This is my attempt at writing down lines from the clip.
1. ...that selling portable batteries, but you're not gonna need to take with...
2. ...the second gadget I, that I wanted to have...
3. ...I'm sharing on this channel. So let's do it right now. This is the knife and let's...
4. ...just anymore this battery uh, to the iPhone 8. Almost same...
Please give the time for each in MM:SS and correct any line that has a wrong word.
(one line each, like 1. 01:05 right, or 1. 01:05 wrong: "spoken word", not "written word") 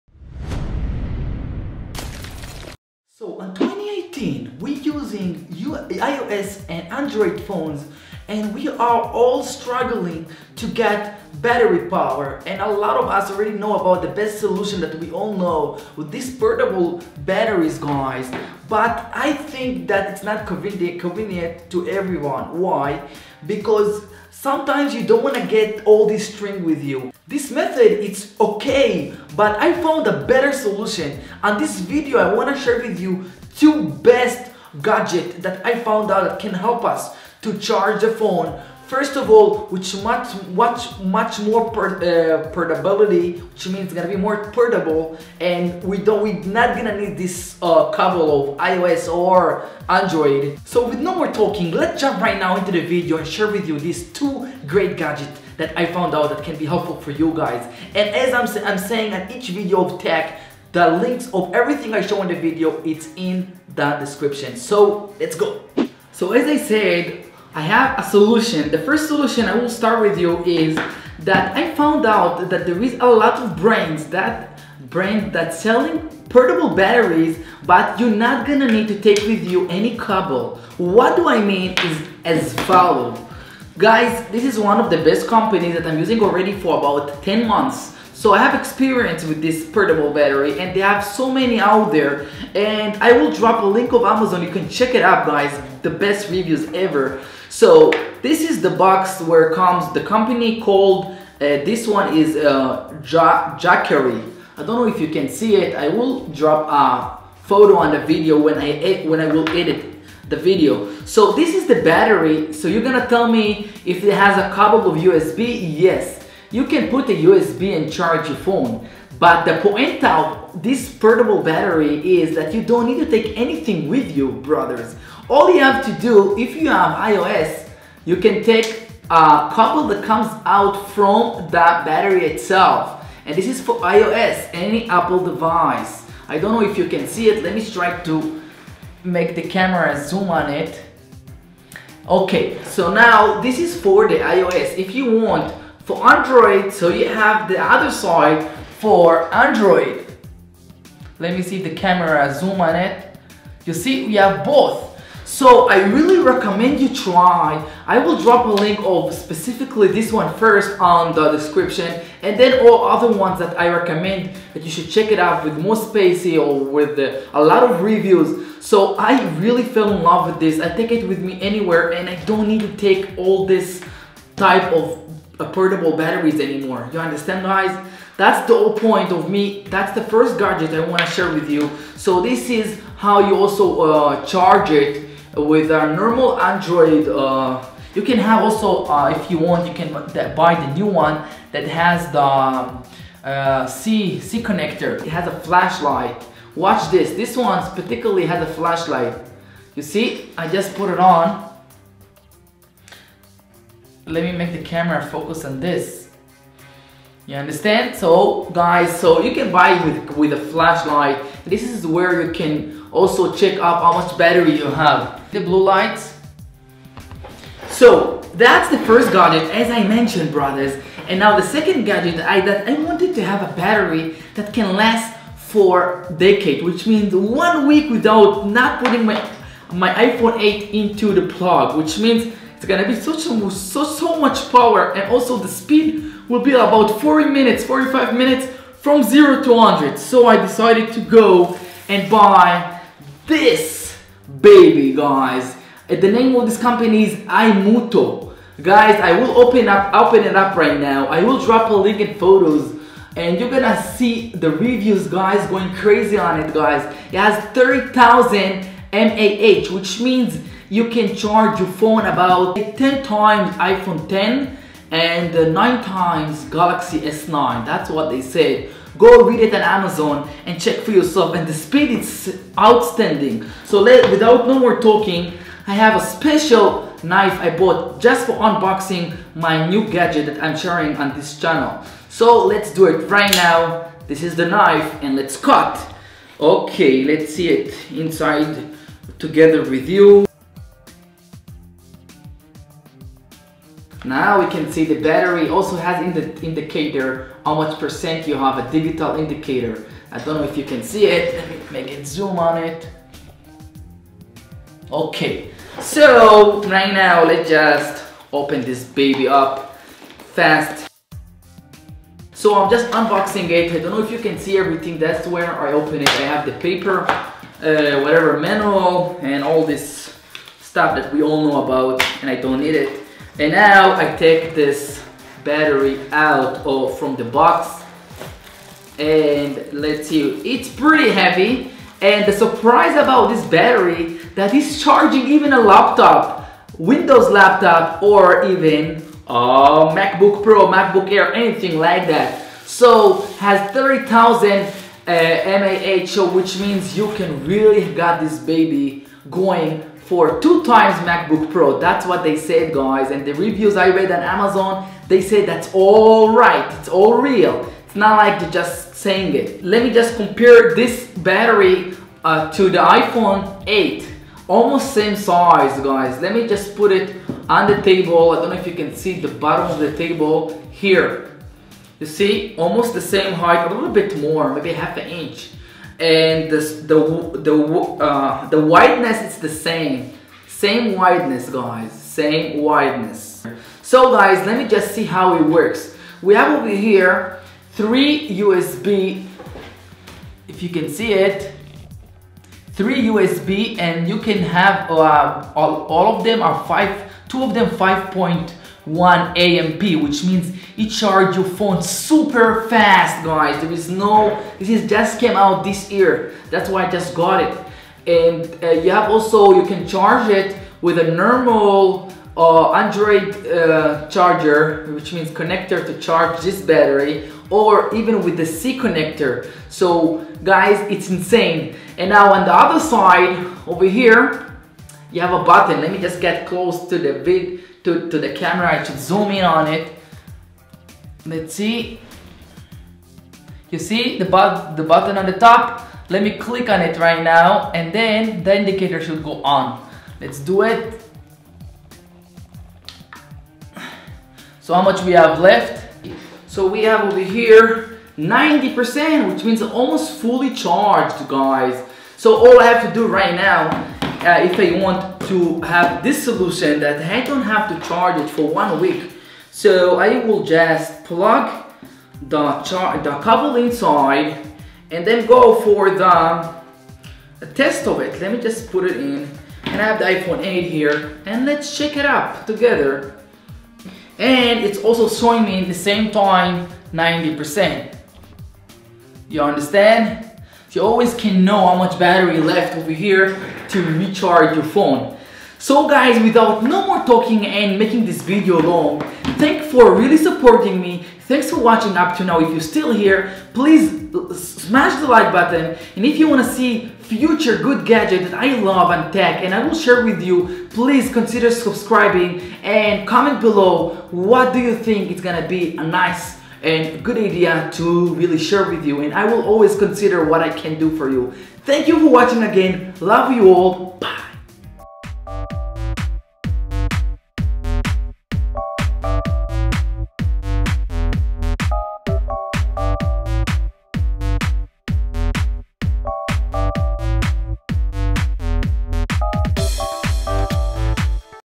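1. 01:15 right
2. 03:41 right
3. 04:40 right
4. 05:59 wrong: "compare", not "anymore".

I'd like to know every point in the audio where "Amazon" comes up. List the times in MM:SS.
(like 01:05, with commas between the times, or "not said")
01:34, 04:29, 05:54.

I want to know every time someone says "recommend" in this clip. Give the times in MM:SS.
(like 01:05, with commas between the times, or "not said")
02:36, 02:43.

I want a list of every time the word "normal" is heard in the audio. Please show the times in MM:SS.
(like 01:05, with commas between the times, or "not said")
03:05, 06:51.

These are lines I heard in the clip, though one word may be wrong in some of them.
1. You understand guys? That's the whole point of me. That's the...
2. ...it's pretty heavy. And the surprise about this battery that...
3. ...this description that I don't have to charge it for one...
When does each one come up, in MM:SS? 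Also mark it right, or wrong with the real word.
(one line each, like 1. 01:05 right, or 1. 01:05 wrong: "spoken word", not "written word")
1. 02:56 right
2. 05:30 right
3. 07:36 wrong: "solution", not "description".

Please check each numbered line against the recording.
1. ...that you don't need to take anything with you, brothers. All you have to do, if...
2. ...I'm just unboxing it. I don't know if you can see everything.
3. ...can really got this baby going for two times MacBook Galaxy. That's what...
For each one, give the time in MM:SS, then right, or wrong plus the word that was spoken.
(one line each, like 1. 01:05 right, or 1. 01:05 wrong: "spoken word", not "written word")
1. 02:02 right
2. 05:12 right
3. 05:47 wrong: "Pro", not "Galaxy".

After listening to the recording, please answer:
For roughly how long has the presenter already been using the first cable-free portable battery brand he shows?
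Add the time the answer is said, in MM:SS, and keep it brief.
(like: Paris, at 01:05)
10 months, at 01:27.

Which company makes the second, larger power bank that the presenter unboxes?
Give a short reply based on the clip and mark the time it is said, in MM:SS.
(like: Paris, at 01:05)
iMuto, at 04:07.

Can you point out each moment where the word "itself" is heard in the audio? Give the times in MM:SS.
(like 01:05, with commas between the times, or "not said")
02:12.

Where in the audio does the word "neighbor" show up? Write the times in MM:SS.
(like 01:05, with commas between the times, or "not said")
not said.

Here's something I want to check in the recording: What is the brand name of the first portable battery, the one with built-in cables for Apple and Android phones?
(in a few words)
Jackery.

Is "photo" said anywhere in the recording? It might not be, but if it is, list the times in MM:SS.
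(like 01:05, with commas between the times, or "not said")
01:47, 04:12.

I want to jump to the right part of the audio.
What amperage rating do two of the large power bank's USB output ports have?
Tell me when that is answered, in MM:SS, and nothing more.
06:37.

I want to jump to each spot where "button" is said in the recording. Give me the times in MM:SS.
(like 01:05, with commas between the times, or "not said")
07:05, 07:14, 08:15.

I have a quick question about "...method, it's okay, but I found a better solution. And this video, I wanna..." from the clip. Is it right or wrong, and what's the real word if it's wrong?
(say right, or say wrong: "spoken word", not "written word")
right.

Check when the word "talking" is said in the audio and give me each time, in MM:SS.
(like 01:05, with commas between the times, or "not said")
00:51, 04:34, 08:07.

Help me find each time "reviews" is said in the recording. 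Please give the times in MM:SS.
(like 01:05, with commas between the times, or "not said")
01:36, 02:47, 04:14, 05:53.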